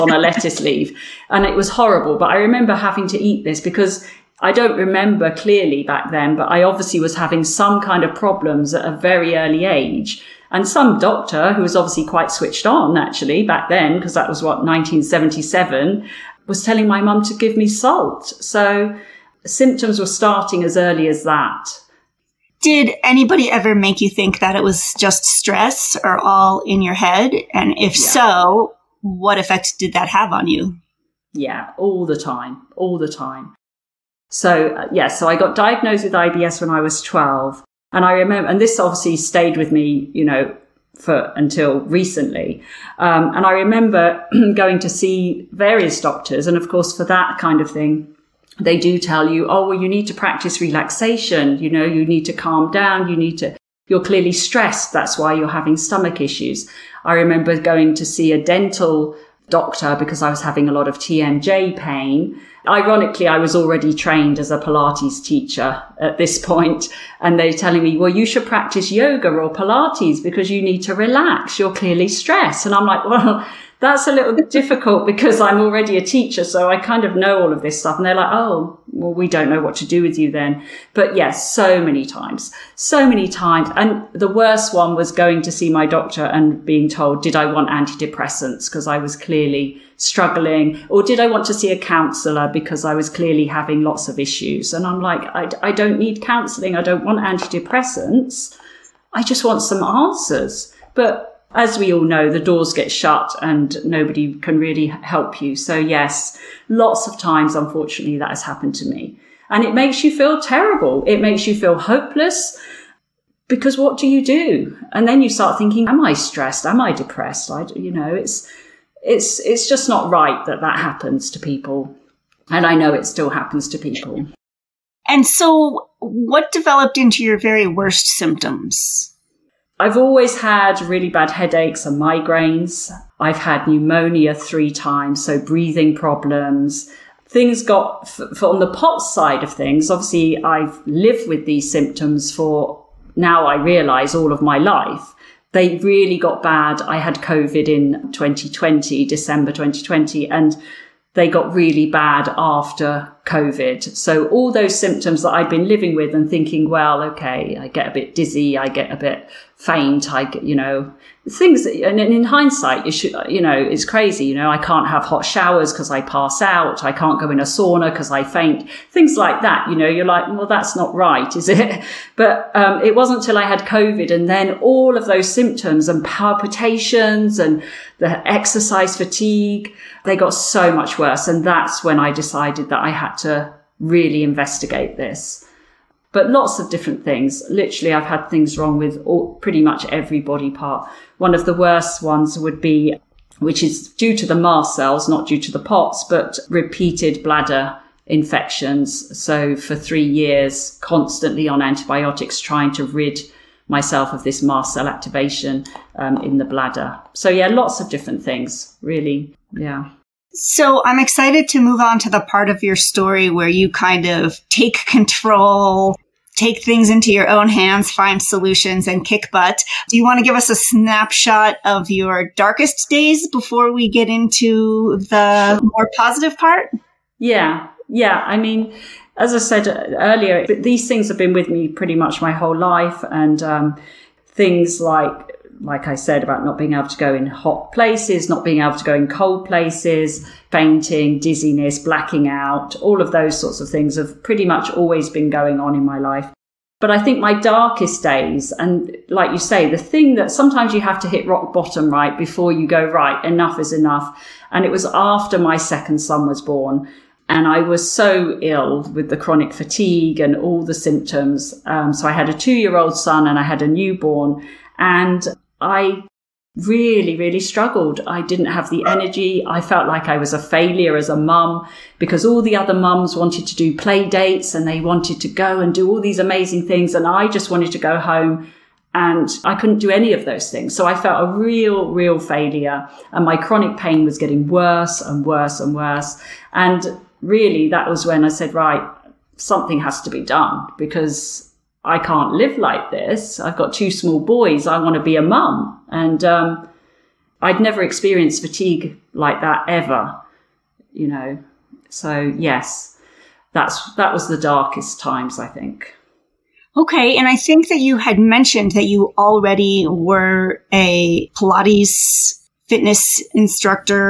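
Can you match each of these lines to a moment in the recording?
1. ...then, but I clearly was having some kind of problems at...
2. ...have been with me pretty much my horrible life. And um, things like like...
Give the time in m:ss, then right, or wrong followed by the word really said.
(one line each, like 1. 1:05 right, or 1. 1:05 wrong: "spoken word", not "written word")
1. 0:06 wrong: "obviously", not "clearly"
2. 3:51 wrong: "whole", not "horrible".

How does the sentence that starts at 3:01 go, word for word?
And that's when I decided that I had to really investigate this.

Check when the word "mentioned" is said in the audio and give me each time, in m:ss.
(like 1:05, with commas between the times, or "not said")
5:08.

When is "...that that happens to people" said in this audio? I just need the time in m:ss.
2:00.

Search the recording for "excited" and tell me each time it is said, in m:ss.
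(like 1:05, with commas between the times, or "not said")
3:30.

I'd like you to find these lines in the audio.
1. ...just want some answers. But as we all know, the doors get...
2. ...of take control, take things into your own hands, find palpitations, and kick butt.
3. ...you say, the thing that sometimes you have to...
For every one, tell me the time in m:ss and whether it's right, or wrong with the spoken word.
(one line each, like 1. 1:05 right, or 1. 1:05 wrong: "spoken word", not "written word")
1. 1:39 right
2. 3:34 wrong: "solutions", not "palpitations"
3. 4:09 right.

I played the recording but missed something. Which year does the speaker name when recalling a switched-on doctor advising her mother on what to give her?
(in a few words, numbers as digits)
1977.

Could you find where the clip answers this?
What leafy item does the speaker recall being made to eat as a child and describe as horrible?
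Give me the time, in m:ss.
0:00.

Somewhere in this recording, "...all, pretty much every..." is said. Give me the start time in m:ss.
3:09.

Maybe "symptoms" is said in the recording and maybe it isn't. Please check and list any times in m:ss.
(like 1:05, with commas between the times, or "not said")
0:19, 2:08, 2:21, 2:34, 2:55, 4:20.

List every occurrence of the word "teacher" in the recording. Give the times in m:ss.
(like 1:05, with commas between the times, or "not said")
1:05, 1:16.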